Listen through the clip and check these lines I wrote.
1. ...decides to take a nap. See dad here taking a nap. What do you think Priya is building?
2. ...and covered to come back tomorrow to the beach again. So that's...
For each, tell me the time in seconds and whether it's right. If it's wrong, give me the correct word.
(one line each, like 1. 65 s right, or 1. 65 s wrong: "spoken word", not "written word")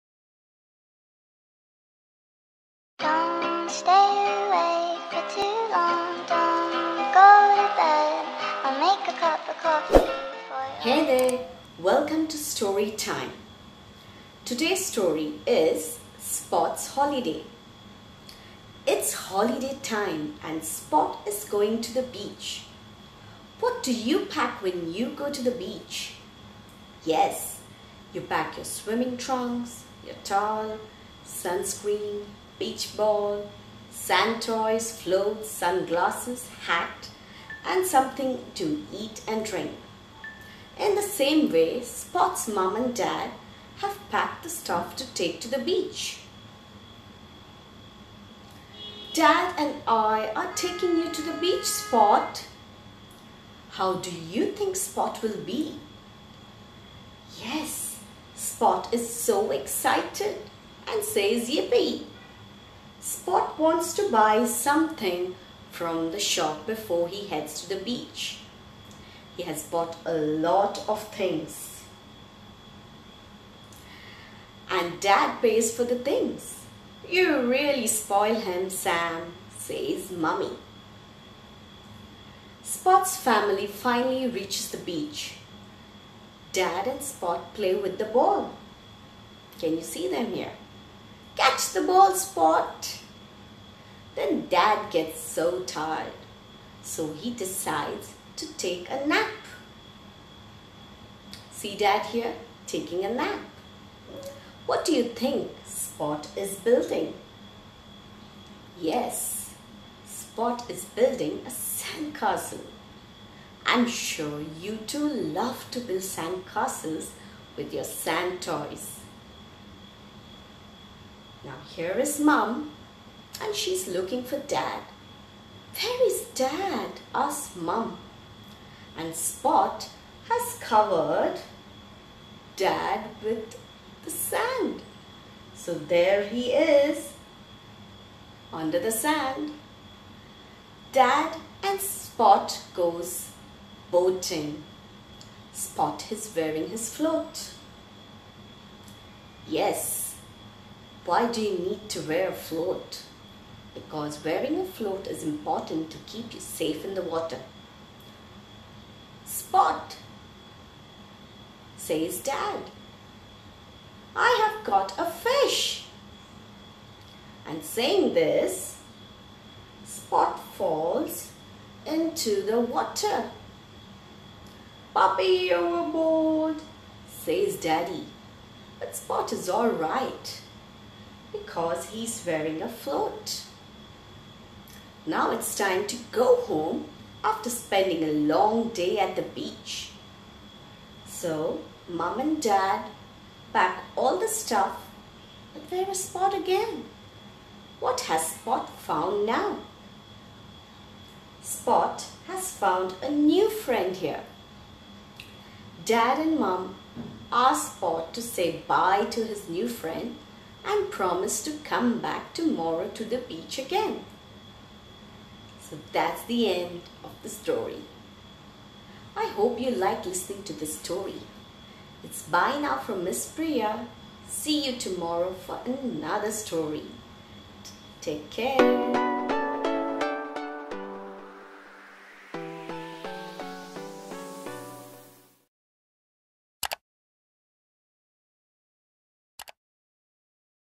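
1. 97 s wrong: "Spot", not "Priya"
2. 210 s wrong: "promised", not "covered".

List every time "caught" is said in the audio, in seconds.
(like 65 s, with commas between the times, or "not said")
164 s.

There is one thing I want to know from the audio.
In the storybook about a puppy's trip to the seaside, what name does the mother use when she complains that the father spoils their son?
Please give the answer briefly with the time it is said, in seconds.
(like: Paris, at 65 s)
Sam, at 78 s.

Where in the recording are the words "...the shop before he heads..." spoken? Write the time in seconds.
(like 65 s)
66 s.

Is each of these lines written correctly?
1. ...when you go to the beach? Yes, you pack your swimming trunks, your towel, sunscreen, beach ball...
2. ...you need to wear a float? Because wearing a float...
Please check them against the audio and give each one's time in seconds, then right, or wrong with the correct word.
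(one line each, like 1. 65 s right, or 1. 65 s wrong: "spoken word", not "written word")
1. 24 s right
2. 151 s right.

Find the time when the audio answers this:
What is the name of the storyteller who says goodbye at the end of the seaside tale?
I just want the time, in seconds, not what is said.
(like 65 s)
223 s.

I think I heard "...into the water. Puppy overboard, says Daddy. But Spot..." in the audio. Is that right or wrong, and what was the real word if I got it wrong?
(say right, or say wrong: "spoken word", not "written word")
right.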